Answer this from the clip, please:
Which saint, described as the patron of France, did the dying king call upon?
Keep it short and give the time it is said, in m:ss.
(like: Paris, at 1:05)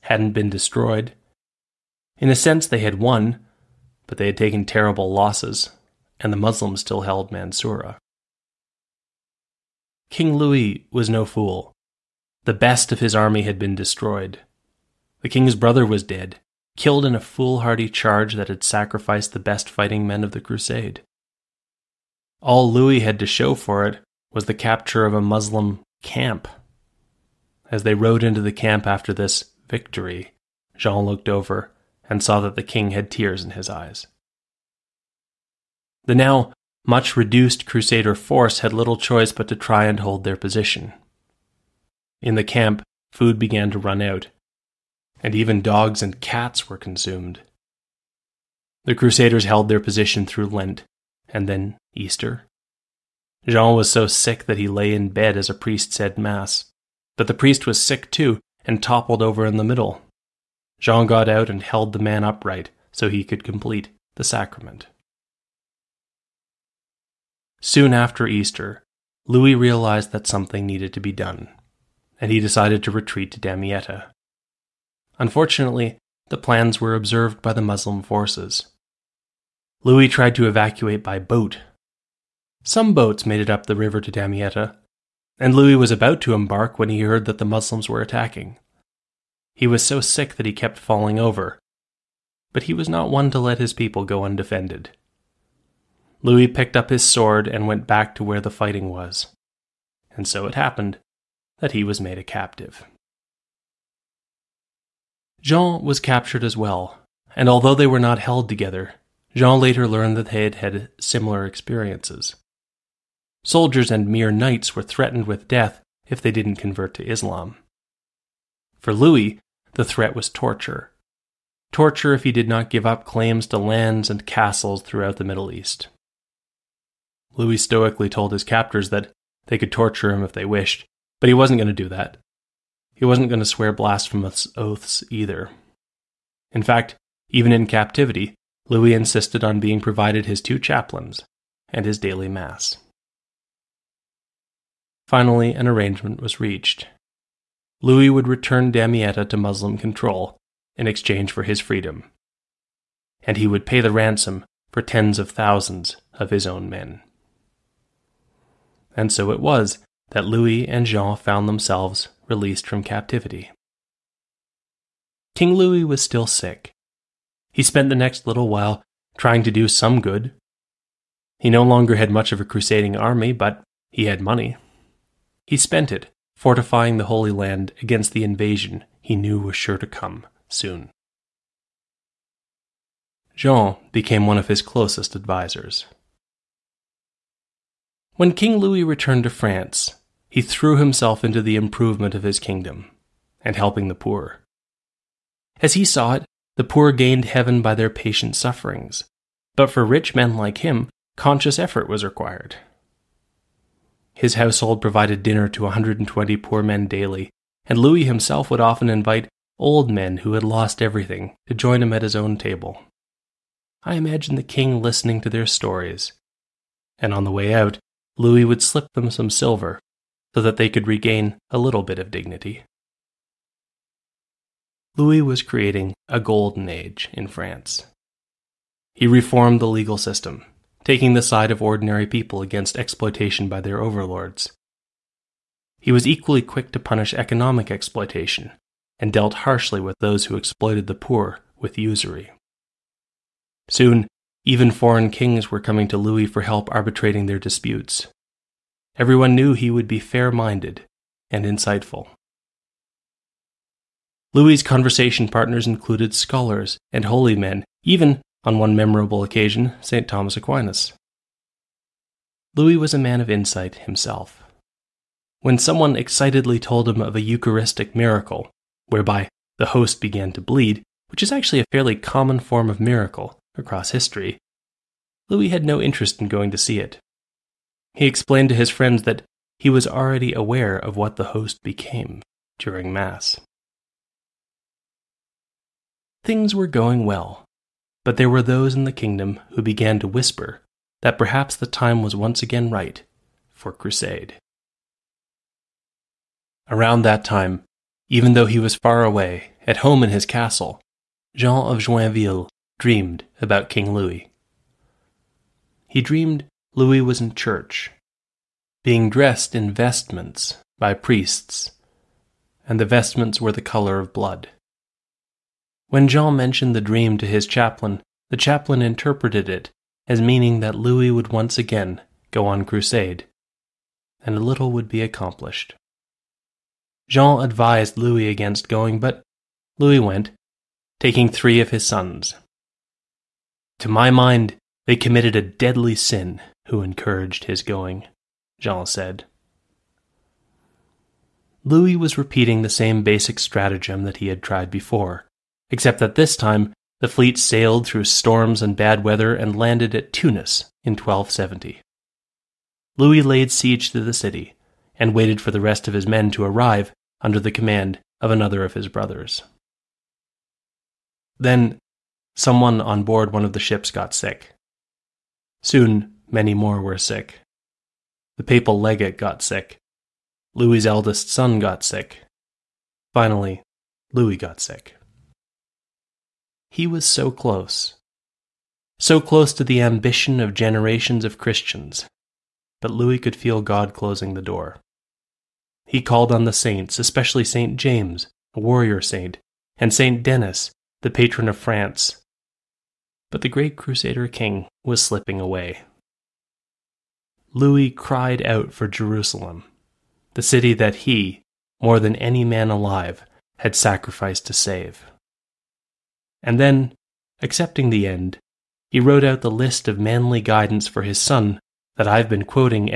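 St. Denis, at 6:29.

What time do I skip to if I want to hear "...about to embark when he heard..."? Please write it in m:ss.
1:25.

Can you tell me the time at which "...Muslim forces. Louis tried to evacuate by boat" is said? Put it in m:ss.
1:17.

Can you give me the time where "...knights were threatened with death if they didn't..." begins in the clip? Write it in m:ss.
1:54.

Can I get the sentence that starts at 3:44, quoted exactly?
Louis was creating a golden age in France.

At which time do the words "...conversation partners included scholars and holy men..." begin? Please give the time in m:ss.
4:14.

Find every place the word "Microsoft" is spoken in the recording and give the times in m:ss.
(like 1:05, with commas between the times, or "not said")
not said.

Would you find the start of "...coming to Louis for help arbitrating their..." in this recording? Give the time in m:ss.
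4:05.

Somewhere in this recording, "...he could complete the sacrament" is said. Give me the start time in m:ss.
1:03.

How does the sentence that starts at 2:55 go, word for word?
He spent it, fortifying the Holy Land against the invasion he knew was sure to come soon.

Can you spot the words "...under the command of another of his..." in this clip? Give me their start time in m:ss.
5:57.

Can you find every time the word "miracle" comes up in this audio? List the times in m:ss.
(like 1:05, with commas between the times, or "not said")
4:27, 4:32.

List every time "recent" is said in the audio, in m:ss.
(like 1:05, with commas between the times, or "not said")
not said.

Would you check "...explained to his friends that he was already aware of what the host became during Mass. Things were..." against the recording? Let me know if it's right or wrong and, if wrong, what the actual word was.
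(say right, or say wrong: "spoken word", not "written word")
right.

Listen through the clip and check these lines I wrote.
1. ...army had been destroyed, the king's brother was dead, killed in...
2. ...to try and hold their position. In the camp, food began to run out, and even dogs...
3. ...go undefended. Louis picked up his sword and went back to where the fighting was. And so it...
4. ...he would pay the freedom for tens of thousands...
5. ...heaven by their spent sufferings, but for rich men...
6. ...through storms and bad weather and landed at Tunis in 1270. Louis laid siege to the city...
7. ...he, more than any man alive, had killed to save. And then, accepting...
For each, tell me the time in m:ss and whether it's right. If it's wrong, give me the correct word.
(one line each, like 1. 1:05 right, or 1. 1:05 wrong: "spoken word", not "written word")
1. 0:13 right
2. 0:39 right
3. 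1:34 right
4. 2:33 wrong: "ransom", not "freedom"
5. 3:17 wrong: "patient", not "spent"
6. 5:47 right
7. 6:41 wrong: "sacrificed", not "killed".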